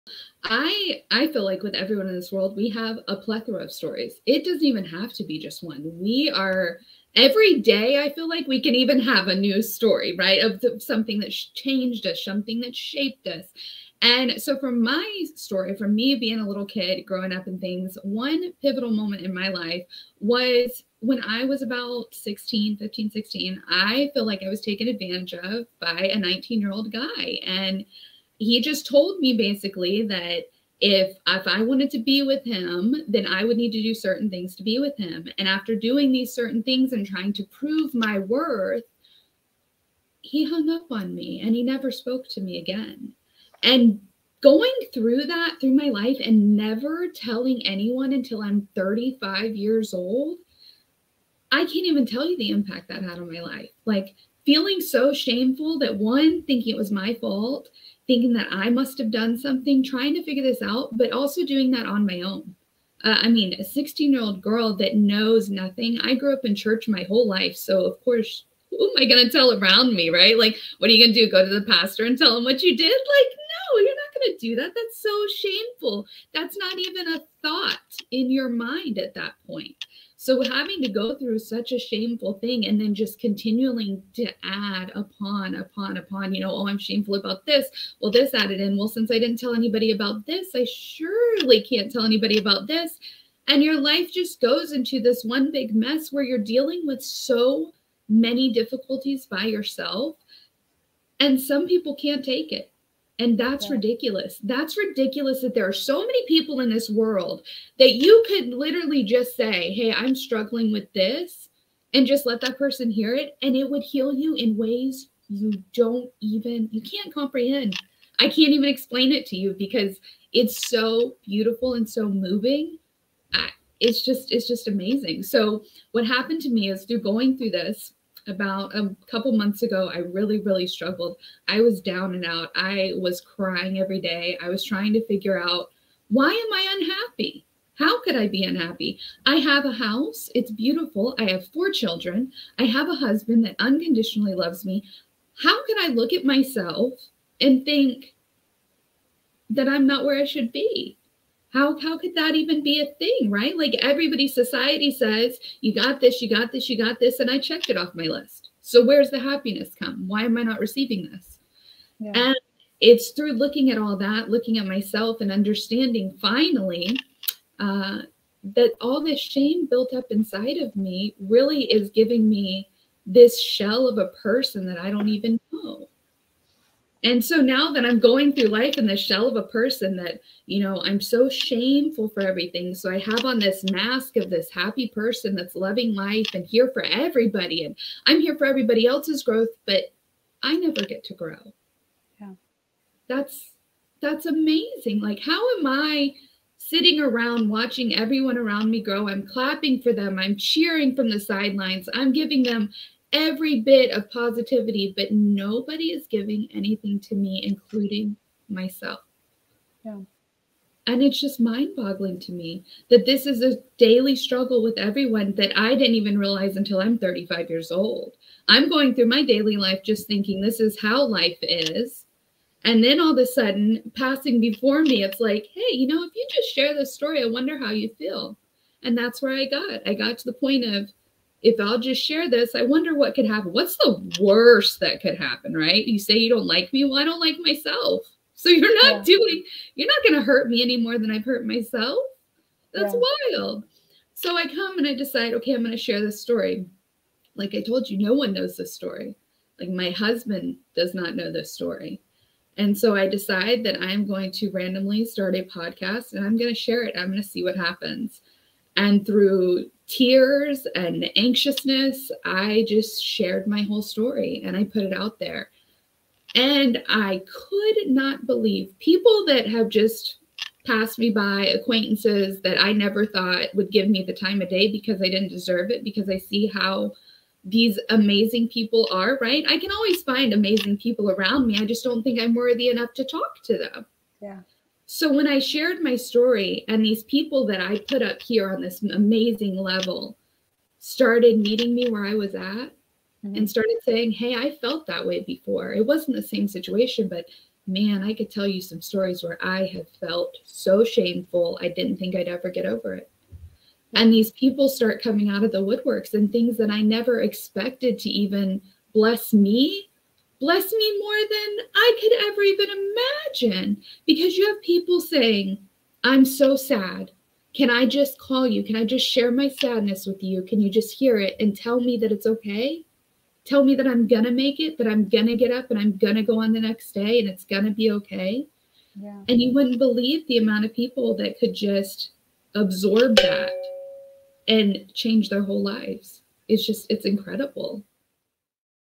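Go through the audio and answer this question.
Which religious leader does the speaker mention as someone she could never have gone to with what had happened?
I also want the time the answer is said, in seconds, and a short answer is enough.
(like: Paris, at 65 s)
The pastor, at 71 s.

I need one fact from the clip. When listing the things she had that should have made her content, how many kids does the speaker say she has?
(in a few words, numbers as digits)
4.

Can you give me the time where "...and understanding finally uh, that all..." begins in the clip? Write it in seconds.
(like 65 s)
165 s.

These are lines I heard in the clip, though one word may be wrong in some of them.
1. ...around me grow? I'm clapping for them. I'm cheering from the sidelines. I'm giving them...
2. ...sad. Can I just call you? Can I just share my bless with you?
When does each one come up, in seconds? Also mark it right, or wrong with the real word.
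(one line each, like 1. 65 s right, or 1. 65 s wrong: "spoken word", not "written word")
1. 198 s right
2. 316 s wrong: "sadness", not "bless".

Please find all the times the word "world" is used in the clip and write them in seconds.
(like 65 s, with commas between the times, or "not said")
2 s, 106 s.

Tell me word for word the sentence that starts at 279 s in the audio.
I can always find amazing people around me.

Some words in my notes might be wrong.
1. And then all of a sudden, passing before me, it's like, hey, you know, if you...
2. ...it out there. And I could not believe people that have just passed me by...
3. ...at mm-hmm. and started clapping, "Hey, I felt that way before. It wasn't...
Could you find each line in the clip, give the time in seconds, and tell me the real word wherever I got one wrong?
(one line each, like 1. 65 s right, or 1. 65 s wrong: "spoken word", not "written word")
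1. 222 s right
2. 264 s right
3. 292 s wrong: "saying", not "clapping".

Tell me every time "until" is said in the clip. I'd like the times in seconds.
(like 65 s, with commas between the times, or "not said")
48 s, 216 s.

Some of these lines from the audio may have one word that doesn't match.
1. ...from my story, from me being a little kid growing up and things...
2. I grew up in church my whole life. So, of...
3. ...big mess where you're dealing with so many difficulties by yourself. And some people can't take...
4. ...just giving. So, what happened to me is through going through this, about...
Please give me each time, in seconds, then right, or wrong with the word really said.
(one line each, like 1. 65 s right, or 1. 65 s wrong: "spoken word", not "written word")
1. 14 s right
2. 66 s right
3. 95 s right
4. 124 s wrong: "amazing", not "giving".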